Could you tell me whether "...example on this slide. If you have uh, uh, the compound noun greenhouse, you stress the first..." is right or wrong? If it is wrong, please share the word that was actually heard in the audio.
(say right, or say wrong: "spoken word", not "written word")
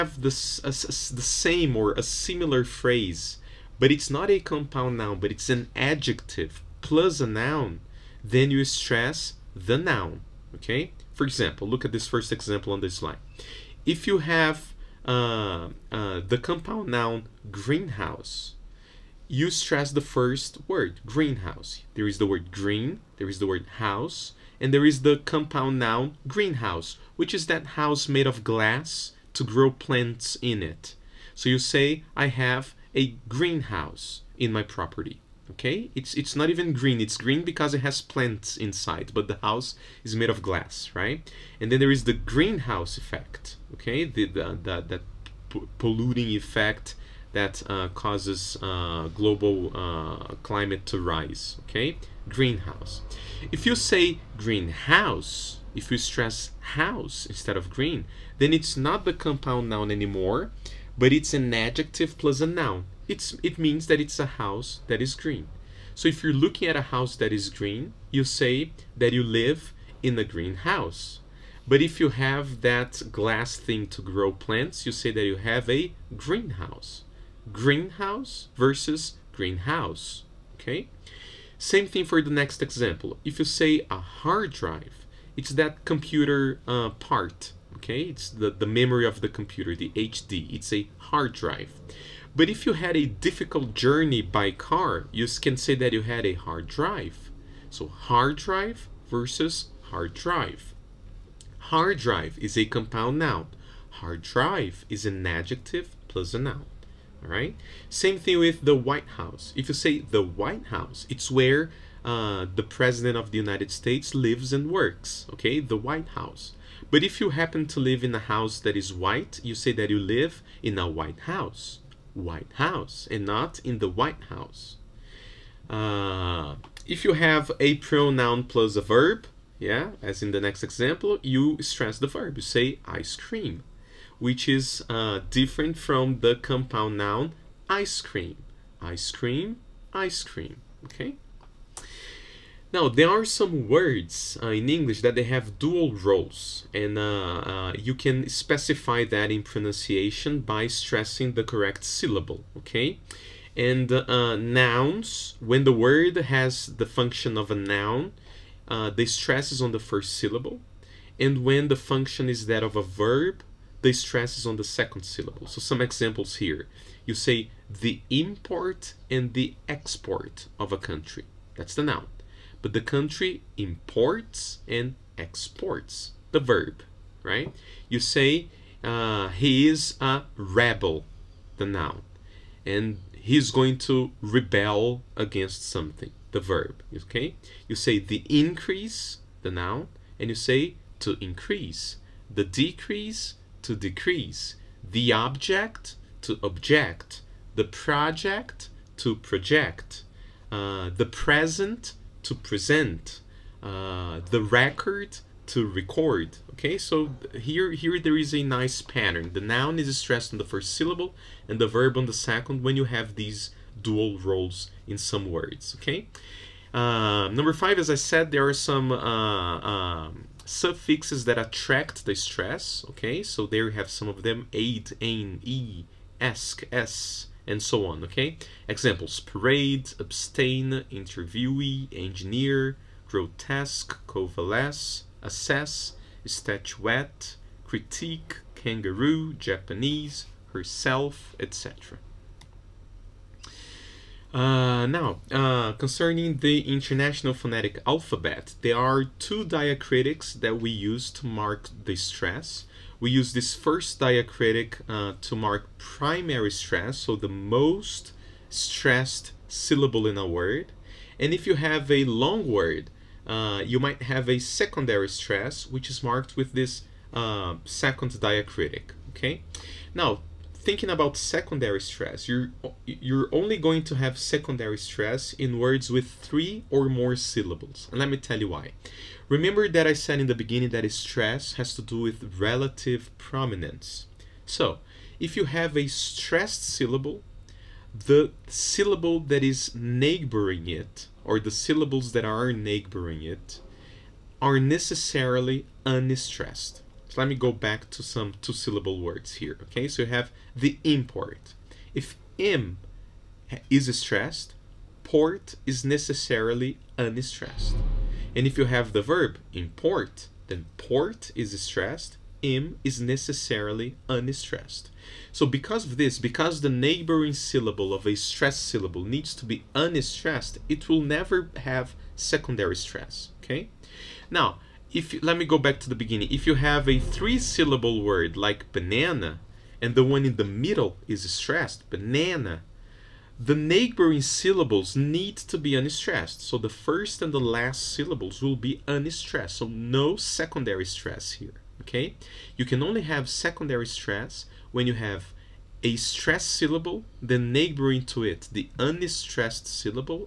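right.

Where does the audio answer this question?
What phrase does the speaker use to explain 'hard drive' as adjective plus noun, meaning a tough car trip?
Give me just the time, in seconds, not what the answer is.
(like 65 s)
93 s.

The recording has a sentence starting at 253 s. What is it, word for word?
We use this first diacritic uh, to mark primary stress, so the most stressed syllable in a word.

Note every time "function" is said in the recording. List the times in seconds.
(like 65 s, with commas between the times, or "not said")
156 s, 161 s.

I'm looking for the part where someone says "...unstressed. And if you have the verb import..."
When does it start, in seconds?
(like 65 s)
306 s.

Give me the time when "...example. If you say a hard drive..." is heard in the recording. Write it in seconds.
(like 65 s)
82 s.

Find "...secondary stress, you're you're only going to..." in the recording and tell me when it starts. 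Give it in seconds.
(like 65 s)
271 s.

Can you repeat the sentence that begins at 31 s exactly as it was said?
So you say, I have a greenhouse in my property okay?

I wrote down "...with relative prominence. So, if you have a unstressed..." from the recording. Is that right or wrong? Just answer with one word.
wrong.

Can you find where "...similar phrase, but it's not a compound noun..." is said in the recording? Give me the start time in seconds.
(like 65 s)
2 s.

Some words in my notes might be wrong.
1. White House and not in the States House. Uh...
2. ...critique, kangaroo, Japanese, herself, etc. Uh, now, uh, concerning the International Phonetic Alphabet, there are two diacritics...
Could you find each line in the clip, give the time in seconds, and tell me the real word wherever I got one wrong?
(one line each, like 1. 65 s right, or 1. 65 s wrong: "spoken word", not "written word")
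1. 122 s wrong: "White", not "States"
2. 237 s right.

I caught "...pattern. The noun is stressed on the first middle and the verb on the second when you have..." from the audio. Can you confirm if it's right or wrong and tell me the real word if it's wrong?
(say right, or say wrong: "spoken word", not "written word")
wrong: "syllable", not "middle".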